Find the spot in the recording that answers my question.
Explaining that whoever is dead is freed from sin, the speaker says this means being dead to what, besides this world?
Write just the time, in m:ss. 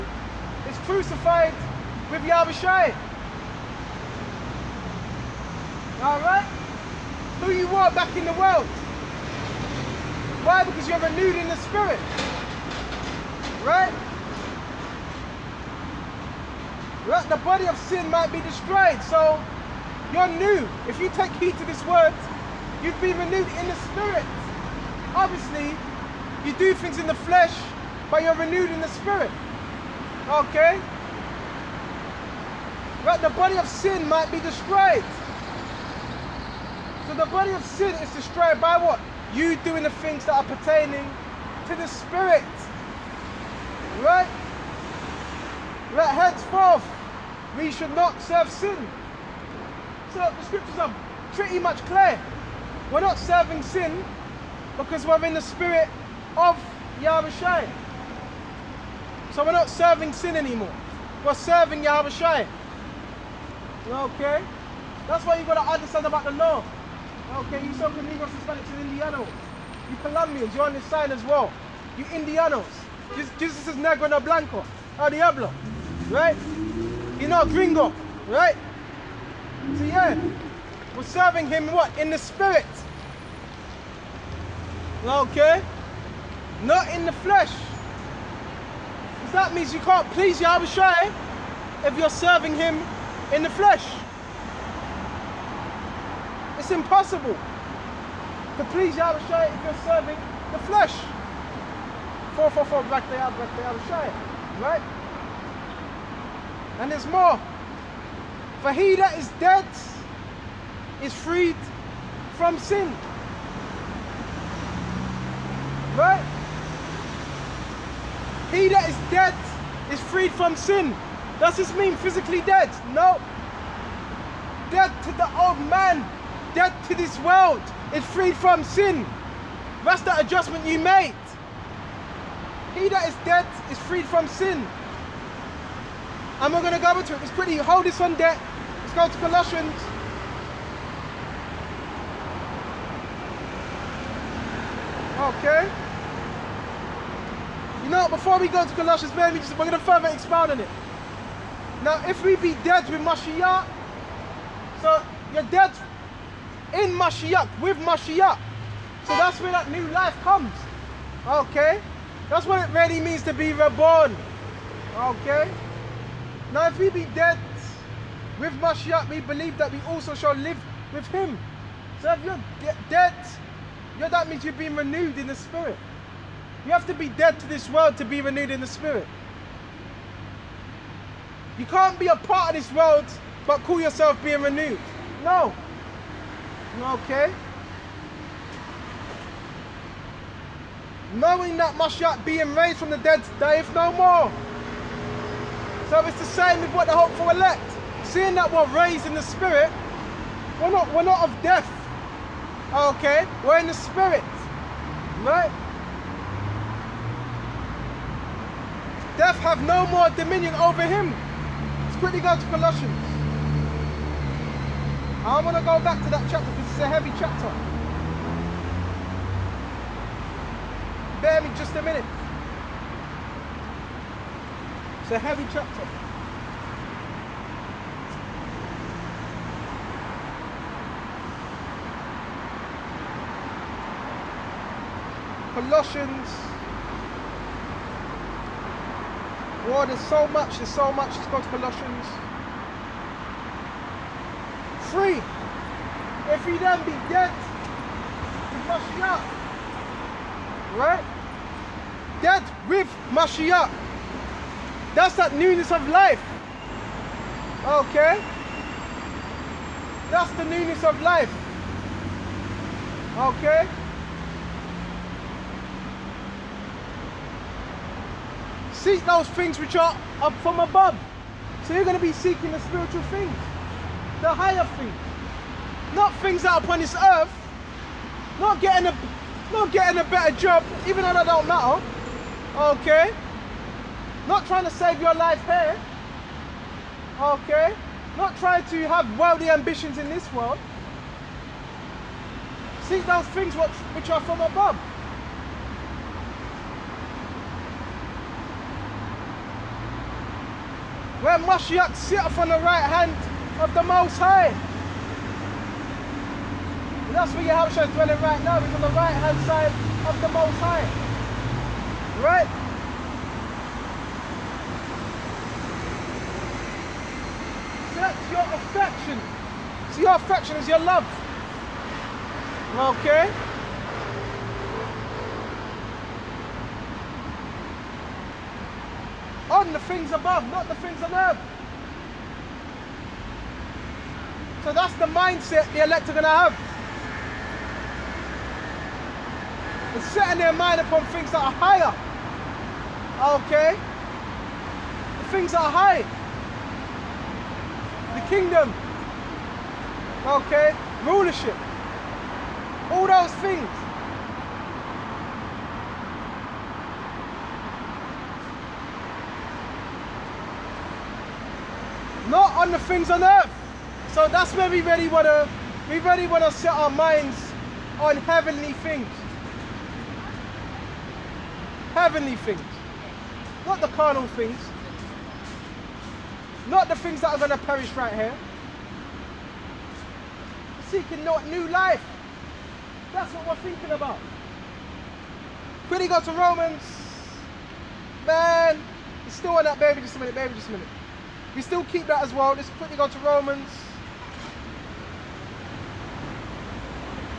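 2:05.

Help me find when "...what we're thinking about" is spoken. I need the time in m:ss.
6:23.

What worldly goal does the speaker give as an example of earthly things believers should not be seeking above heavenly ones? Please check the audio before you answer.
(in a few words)
a better job.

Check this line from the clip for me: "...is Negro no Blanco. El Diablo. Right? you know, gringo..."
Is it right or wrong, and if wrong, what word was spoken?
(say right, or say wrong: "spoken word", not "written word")
right.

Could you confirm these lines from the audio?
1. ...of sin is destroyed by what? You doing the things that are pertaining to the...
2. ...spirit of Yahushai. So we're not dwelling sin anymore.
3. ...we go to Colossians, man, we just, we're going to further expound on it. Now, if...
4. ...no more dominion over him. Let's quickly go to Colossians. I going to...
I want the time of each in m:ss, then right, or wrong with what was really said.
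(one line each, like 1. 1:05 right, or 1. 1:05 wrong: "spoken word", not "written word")
1. 0:37 right
2. 0:55 wrong: "serving", not "dwelling"
3. 2:28 right
4. 3:29 right.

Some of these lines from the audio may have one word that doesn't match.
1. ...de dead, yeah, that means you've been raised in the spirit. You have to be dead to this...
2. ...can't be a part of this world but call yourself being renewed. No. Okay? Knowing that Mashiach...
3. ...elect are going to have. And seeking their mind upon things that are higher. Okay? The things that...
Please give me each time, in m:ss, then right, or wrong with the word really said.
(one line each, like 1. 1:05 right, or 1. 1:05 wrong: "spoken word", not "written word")
1. 2:52 wrong: "renewed", not "raised"
2. 3:01 right
3. 5:35 wrong: "setting", not "seeking".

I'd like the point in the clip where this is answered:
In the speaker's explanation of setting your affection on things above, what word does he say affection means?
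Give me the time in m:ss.
5:20.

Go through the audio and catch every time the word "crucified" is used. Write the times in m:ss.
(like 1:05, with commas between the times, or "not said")
0:00.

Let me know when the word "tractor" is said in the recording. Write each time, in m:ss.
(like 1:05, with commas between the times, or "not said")
3:45.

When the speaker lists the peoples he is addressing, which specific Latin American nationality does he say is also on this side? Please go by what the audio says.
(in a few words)
Colombians.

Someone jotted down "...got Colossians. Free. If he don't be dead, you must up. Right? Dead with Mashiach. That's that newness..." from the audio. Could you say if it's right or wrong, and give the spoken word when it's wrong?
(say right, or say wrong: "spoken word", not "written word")
right.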